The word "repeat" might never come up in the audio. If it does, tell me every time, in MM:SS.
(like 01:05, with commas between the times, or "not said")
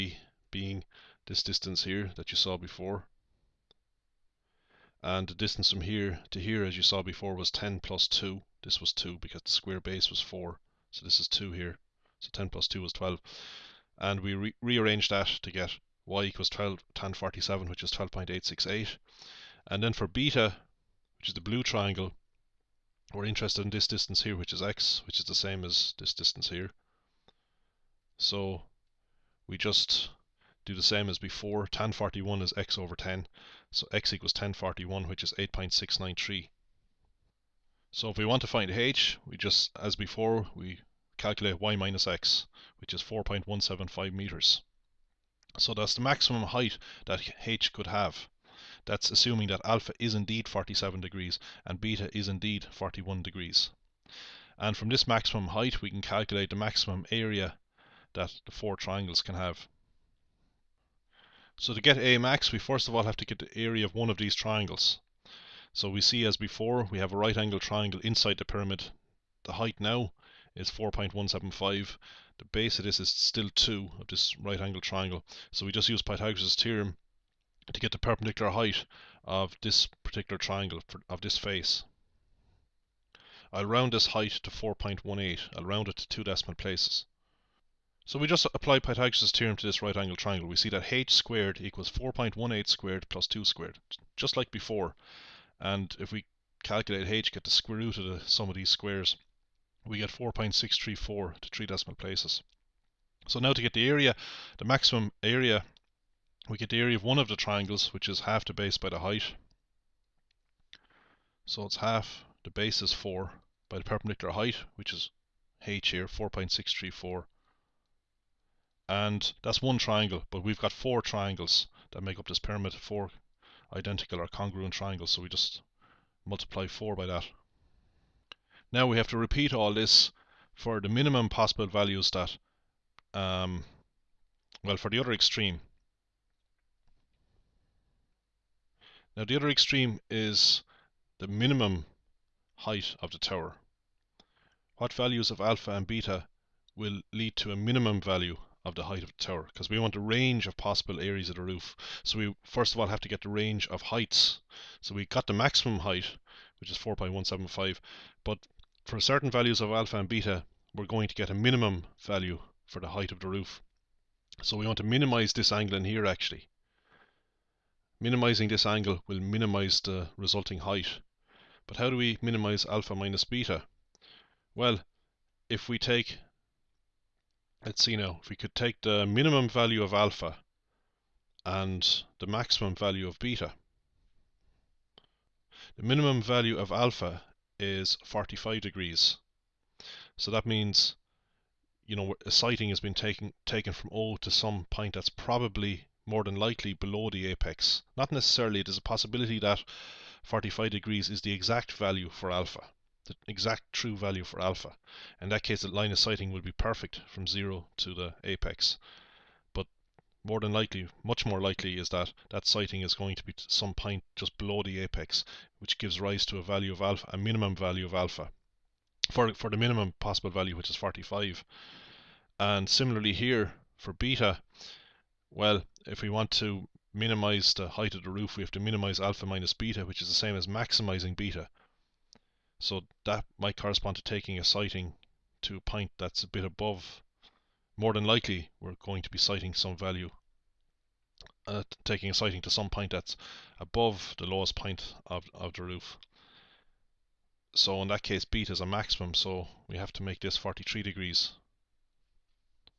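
02:09.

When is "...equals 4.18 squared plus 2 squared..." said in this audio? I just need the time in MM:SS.
01:31.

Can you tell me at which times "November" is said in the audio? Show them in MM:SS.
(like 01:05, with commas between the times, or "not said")
not said.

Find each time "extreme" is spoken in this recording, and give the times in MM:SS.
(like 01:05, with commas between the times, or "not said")
02:15, 02:19.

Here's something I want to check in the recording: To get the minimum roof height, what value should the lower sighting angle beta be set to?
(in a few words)
43 degrees.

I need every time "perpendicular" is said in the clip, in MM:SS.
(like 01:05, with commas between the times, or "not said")
01:17, 01:53.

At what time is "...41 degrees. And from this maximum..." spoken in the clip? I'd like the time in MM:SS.
00:52.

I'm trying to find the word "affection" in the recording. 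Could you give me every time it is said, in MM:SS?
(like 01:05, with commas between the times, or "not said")
not said.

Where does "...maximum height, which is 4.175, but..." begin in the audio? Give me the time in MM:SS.
02:35.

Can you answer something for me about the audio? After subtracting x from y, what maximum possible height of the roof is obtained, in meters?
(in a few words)
4.175 meters.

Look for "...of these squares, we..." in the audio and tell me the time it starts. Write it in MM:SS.
01:38.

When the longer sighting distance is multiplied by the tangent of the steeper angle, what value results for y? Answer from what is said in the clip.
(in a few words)
12.868.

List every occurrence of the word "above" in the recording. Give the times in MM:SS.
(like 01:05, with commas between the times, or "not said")
03:56, 04:03.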